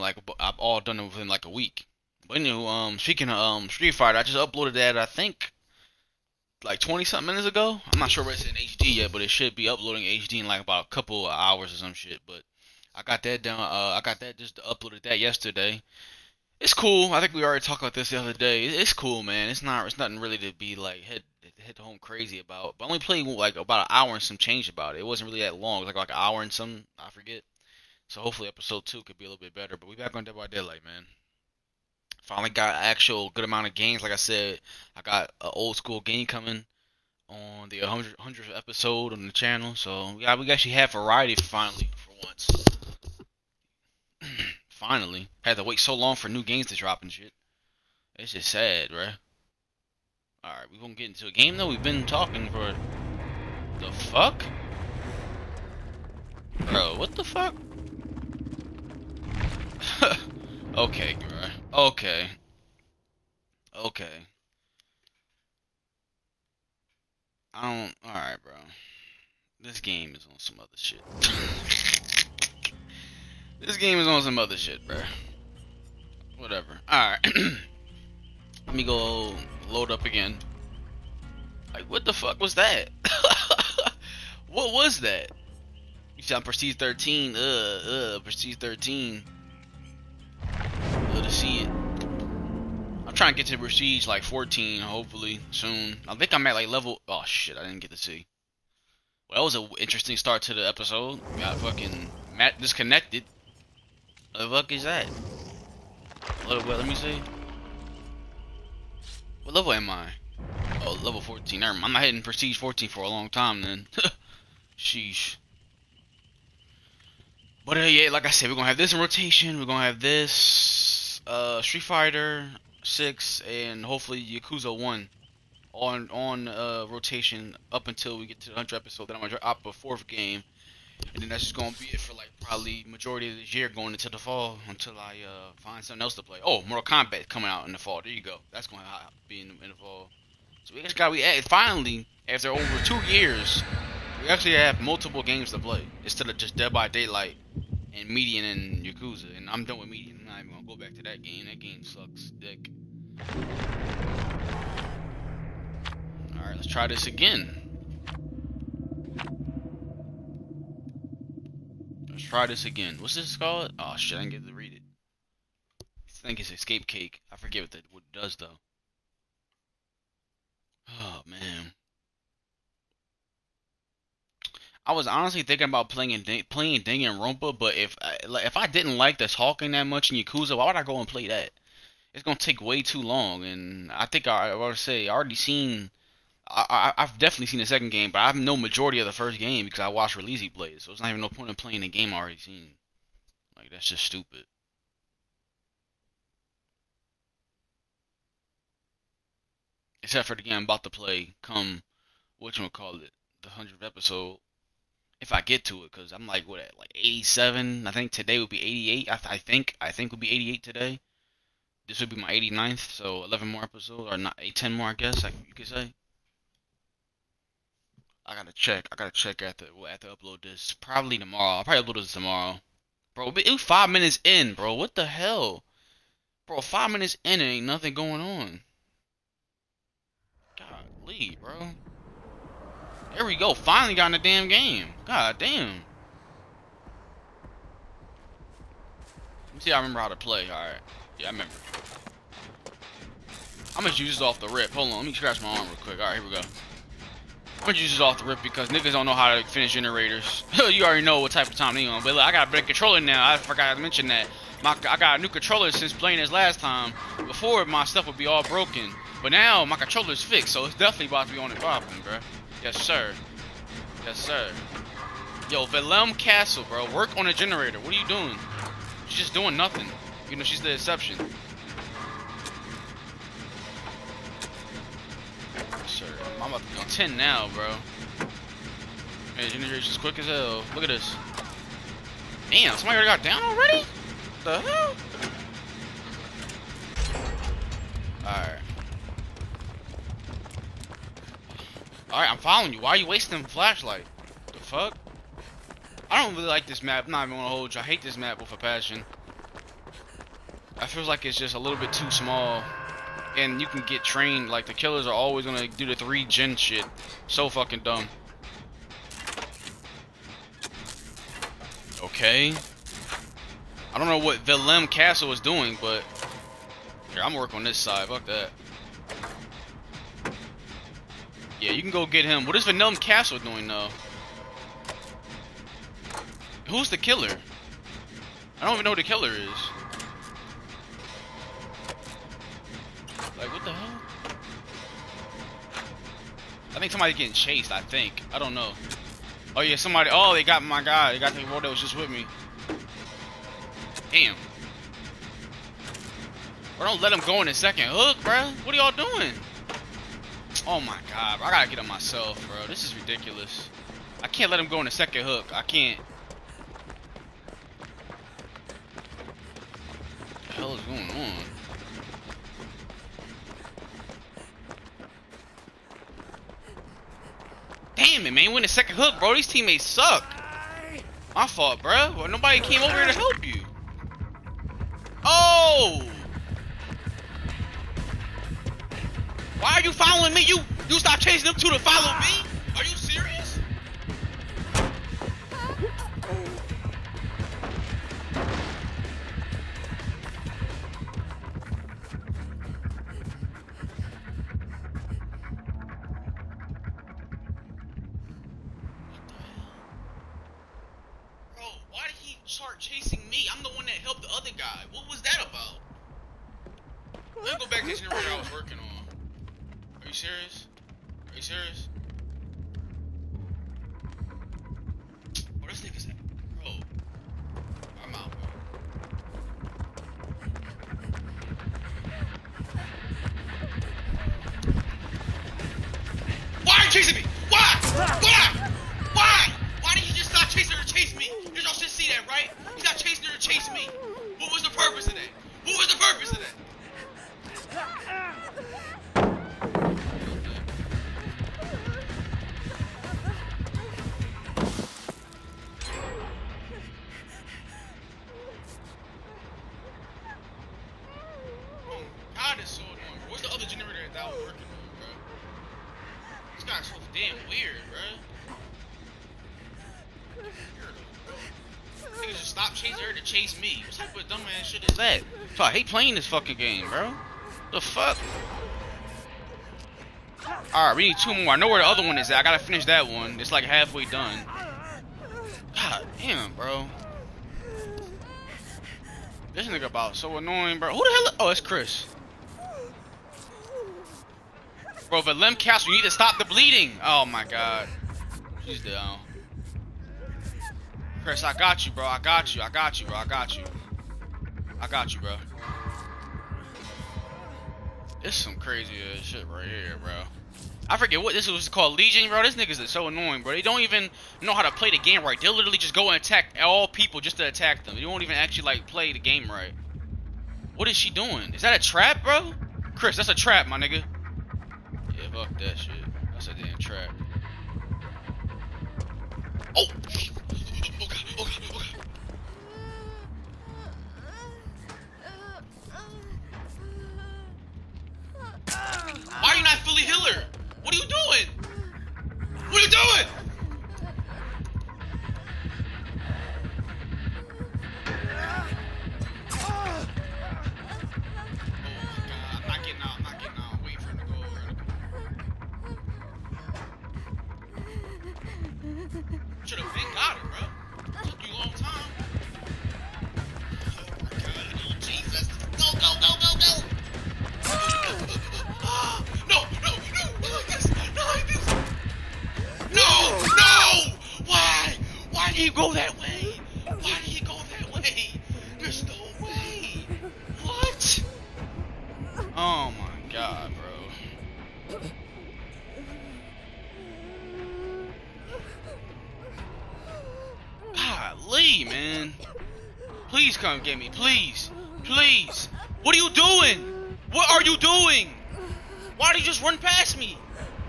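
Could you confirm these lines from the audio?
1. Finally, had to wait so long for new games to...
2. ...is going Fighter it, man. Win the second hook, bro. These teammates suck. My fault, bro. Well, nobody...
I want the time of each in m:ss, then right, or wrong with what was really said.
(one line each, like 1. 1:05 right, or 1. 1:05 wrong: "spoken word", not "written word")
1. 0:44 right
2. 6:00 wrong: "Damn", not "Fighter".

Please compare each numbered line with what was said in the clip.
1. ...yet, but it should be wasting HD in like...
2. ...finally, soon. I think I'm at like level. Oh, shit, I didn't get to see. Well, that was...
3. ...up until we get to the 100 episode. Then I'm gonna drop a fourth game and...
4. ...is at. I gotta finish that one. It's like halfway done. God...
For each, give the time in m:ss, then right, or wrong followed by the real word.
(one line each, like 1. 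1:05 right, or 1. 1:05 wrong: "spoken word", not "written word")
1. 0:08 wrong: "uploading", not "wasting"
2. 1:34 wrong: "hopefully", not "finally"
3. 2:07 right
4. 7:52 right.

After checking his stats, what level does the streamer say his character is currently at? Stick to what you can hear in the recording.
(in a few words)
14.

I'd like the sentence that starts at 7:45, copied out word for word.
I hate playing this fucking game, bro.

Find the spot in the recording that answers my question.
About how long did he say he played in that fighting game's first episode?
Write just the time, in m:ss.
0:23.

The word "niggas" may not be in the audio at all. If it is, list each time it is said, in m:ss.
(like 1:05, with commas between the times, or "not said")
4:08, 7:59, 8:22, 8:33.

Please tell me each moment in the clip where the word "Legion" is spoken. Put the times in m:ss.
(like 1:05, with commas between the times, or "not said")
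8:21.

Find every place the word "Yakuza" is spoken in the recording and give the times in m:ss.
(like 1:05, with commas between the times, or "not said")
2:04, 2:28, 3:00.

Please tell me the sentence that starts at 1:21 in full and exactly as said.
Like, what the fuck was that?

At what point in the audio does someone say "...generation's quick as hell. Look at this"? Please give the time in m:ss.
4:39.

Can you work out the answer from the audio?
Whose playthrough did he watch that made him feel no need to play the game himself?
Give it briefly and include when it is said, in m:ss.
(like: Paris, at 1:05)
Releasey, at 3:10.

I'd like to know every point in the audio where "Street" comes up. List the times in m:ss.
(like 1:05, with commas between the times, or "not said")
0:03, 2:01.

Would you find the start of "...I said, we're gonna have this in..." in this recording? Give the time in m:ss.
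1:58.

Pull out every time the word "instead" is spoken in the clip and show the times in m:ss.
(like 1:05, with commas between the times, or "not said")
2:26.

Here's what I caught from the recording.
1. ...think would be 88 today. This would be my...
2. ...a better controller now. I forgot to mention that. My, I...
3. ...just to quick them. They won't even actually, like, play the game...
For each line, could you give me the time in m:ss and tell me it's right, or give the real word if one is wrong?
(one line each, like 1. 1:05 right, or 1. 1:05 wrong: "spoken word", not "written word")
1. 3:29 right
2. 4:12 right
3. 8:27 wrong: "attack", not "quick".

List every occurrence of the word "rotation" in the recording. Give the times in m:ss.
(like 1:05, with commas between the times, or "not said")
1:59, 2:06.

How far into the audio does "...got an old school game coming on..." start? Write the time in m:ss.
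0:35.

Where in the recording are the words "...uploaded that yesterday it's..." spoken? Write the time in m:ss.
0:14.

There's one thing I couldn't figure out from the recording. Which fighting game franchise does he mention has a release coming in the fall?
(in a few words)
Mortal Kombat.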